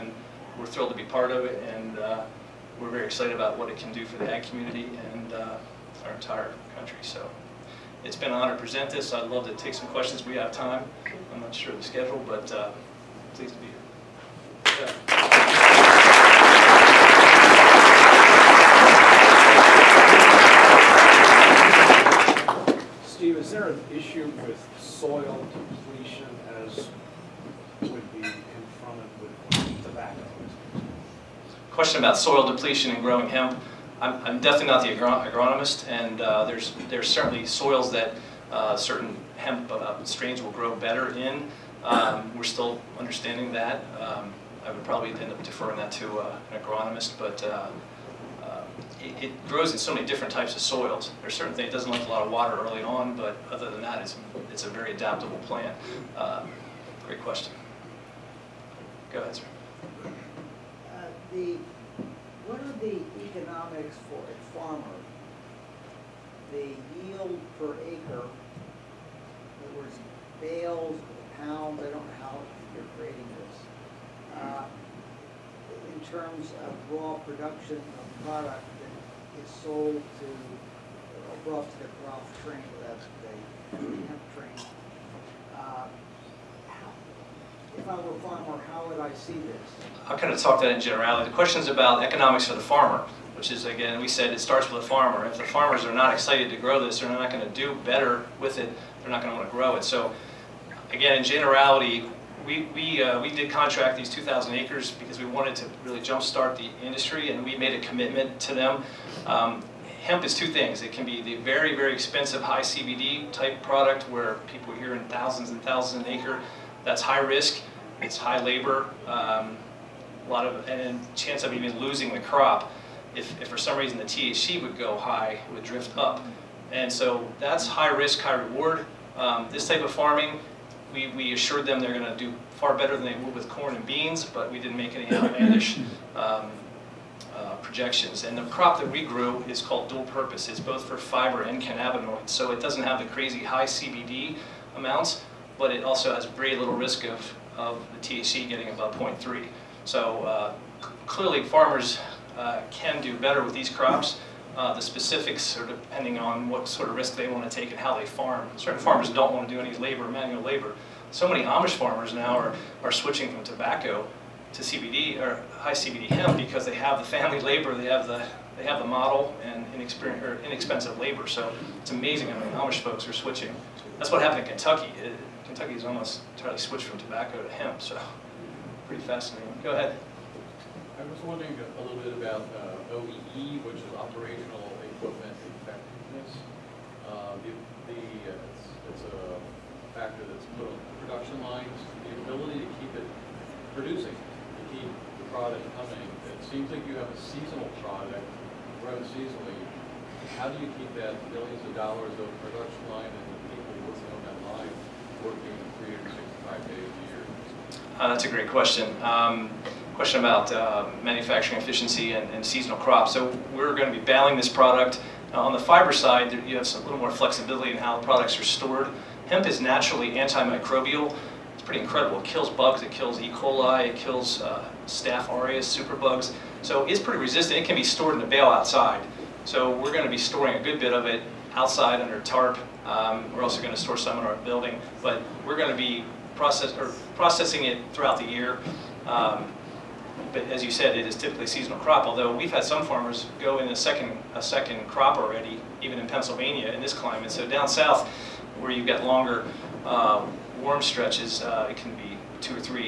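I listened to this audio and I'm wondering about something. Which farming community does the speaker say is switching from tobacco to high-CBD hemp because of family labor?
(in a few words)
Amish farmers.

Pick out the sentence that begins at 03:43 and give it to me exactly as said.
coli, it kills uh, staph aureus, superbugs.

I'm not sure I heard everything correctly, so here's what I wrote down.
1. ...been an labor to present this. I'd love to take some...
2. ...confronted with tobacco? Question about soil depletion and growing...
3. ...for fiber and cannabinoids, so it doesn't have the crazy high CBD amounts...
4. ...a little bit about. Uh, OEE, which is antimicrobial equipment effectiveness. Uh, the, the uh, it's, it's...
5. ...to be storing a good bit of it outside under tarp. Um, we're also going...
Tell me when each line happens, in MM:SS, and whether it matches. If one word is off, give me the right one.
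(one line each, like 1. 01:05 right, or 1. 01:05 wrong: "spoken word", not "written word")
1. 00:08 wrong: "honor", not "labor"
2. 00:28 right
3. 02:20 right
4. 03:01 wrong: "operational", not "antimicrobial"
5. 03:50 right.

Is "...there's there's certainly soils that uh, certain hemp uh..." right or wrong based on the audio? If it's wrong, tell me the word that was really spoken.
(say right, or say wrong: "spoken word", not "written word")
right.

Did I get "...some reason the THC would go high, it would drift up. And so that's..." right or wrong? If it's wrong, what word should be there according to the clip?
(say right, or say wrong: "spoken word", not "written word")
right.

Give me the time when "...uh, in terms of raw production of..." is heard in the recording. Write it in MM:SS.
01:14.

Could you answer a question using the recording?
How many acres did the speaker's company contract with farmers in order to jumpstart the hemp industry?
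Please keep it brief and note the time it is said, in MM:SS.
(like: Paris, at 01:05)
2,000, at 01:44.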